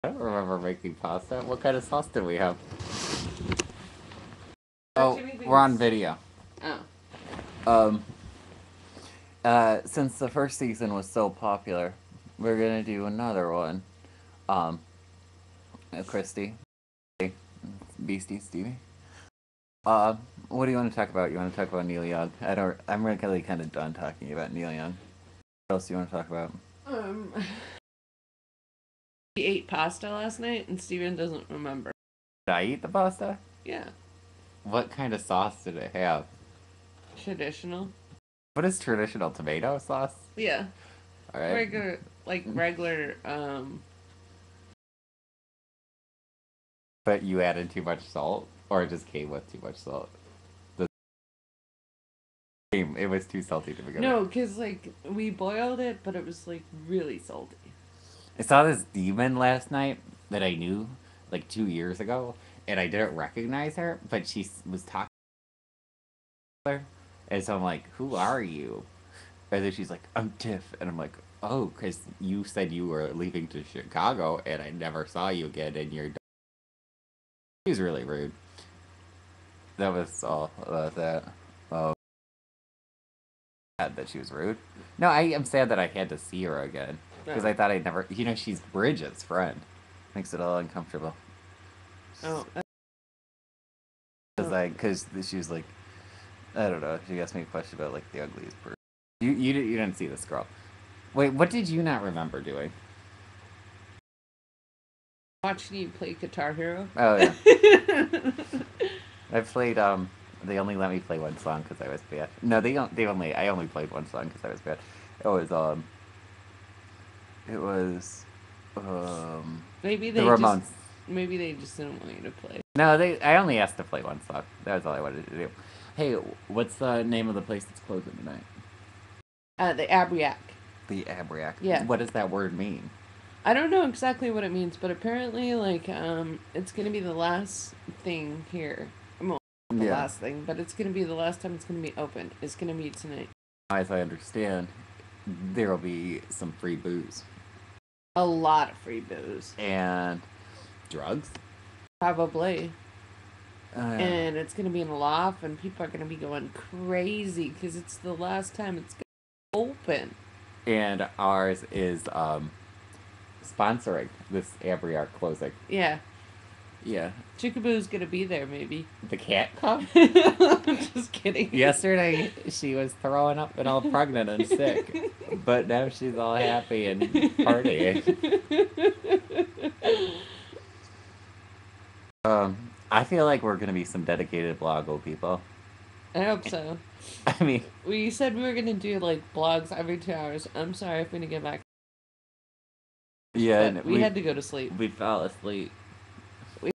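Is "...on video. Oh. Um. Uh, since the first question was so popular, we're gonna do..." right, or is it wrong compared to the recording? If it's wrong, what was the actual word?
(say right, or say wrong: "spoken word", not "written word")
wrong: "season", not "question".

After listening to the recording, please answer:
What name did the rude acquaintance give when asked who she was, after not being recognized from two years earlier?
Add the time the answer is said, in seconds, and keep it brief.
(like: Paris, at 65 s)
Tiff, at 70 s.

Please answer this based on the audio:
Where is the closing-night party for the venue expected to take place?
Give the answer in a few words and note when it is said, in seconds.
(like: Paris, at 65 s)
the loft, at 154 s.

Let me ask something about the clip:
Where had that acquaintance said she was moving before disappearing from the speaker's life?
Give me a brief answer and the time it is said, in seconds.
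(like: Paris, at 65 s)
Chicago, at 73 s.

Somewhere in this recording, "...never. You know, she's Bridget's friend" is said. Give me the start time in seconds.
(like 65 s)
87 s.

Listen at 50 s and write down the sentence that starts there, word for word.
The it was too salty to begin with.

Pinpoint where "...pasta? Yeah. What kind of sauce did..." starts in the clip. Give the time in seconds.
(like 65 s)
32 s.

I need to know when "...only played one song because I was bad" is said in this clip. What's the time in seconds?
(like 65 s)
113 s.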